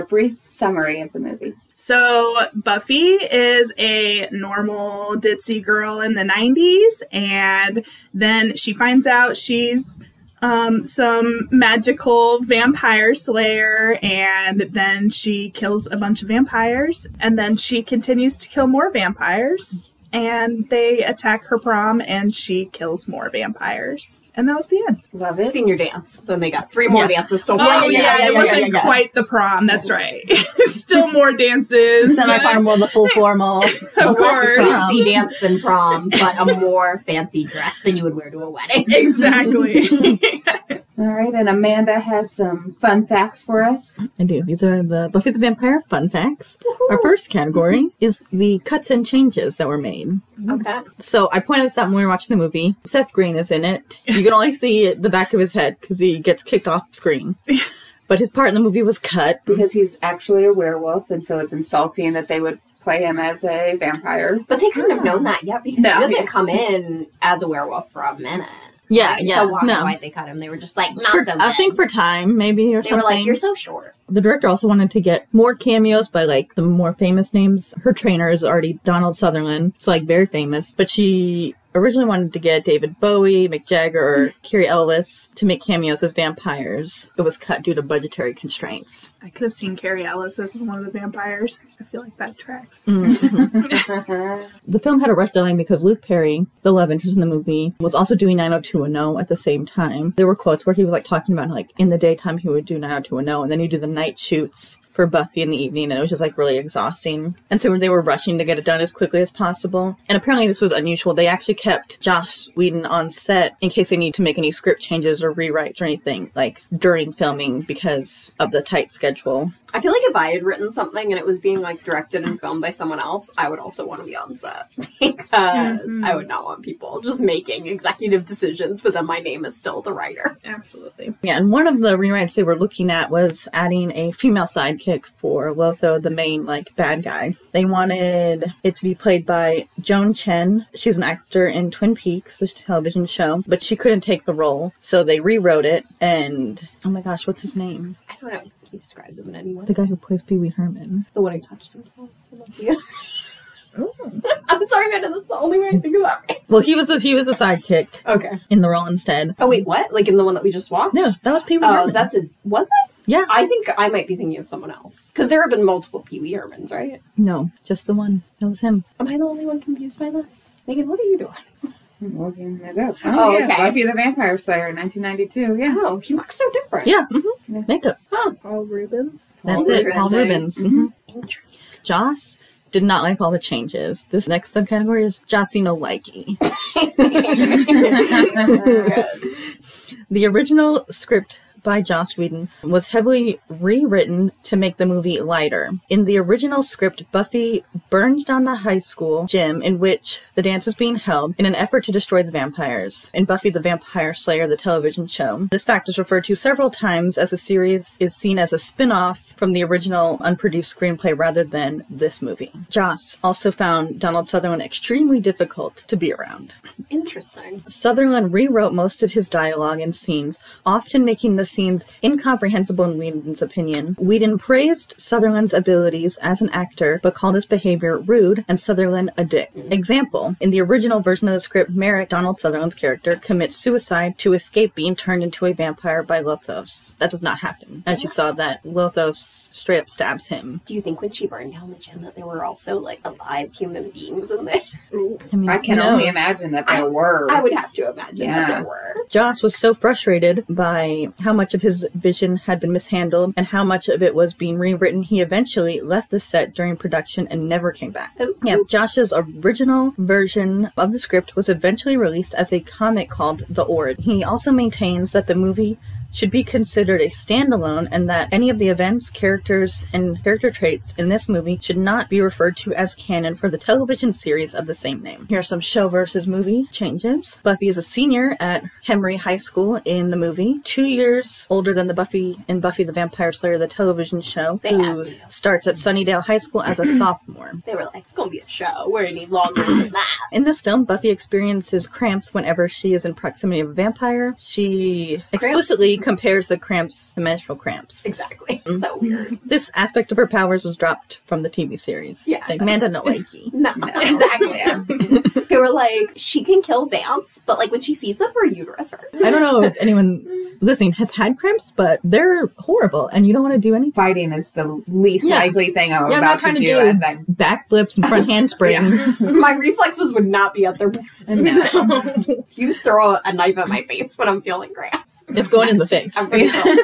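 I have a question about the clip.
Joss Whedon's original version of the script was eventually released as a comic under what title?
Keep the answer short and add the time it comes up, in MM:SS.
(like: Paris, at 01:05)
The Ord, at 04:23.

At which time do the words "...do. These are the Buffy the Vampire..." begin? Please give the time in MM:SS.
00:44.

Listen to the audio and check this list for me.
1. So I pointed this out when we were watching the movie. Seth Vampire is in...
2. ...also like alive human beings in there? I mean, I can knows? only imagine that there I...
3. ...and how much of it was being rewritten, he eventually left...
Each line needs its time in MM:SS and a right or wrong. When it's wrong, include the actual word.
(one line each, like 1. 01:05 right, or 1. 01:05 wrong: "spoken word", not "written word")
1. 00:50 wrong: "Green", not "Vampire"
2. 04:02 right
3. 04:13 right.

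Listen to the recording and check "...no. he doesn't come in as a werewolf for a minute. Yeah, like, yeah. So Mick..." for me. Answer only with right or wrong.
wrong.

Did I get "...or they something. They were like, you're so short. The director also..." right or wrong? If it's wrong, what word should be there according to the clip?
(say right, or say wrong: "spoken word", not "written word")
right.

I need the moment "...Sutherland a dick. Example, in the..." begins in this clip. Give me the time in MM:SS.
03:48.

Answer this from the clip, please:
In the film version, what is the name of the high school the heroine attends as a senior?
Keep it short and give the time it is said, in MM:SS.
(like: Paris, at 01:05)
Henry High School, at 04:38.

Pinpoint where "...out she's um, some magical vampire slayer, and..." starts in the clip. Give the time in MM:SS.
00:09.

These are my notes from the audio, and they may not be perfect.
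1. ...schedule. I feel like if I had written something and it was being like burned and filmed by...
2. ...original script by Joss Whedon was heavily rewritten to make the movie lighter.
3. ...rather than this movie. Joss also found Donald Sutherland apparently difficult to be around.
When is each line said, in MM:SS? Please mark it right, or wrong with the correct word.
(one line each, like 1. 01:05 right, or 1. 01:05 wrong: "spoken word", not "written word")
1. 01:58 wrong: "directed", not "burned"
2. 03:10 right
3. 03:31 wrong: "extremely", not "apparently".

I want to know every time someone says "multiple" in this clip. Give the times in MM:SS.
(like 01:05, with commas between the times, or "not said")
02:45.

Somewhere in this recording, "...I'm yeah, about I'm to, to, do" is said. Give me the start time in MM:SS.
05:15.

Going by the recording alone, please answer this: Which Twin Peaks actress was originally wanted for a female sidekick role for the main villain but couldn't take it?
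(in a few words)
Joan Chen.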